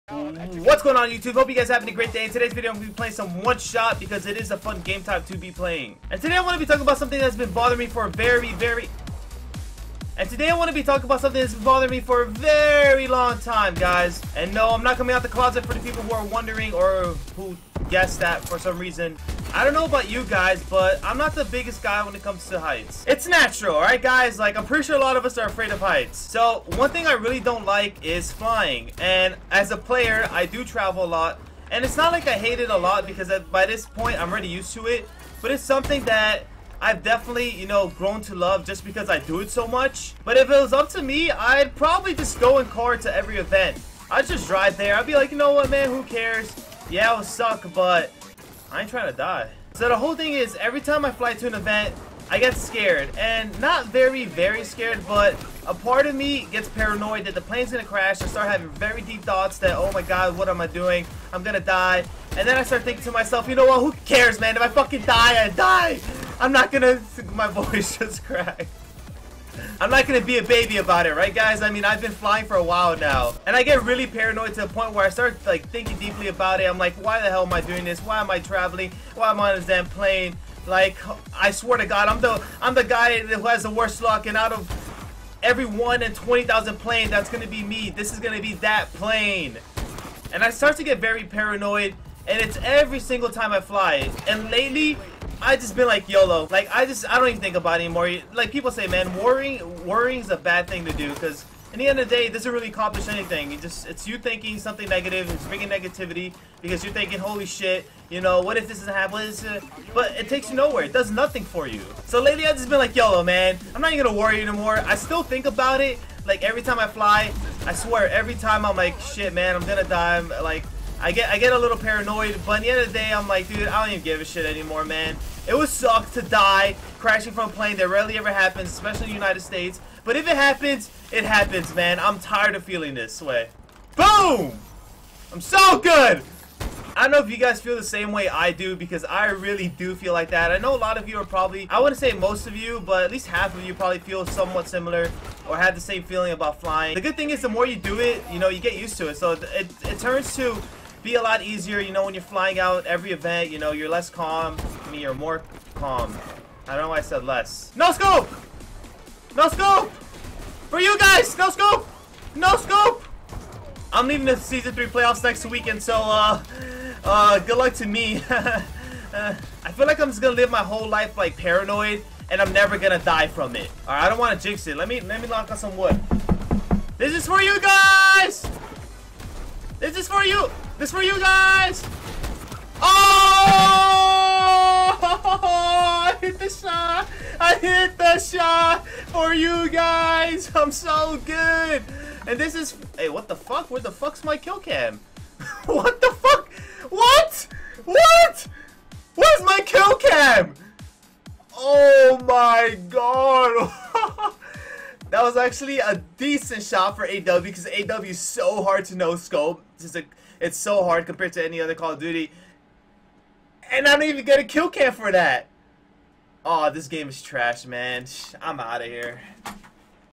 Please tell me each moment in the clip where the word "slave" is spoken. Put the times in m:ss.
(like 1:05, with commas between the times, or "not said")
not said.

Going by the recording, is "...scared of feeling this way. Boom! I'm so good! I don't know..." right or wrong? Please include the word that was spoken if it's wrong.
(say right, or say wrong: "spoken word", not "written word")
wrong: "tired", not "scared".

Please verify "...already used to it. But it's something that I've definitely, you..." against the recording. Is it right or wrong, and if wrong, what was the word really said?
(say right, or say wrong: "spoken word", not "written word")
right.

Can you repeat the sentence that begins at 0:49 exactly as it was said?
So the whole thing is, every time I fly to an event, I get scared.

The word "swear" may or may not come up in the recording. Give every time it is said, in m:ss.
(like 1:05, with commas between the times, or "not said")
1:21, 1:57.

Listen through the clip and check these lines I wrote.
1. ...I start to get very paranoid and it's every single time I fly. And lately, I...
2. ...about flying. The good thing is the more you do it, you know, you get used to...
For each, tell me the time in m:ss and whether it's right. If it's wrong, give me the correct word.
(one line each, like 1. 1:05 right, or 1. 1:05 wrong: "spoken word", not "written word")
1. 1:30 right
2. 2:26 right.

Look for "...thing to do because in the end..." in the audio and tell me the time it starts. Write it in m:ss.
1:40.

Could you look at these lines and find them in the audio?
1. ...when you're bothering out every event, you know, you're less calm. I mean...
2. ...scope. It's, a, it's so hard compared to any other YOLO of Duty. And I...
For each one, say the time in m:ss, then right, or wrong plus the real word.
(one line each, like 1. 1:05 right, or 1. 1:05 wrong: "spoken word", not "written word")
1. 2:32 wrong: "flying", not "bothering"
2. 3:29 wrong: "Call", not "YOLO".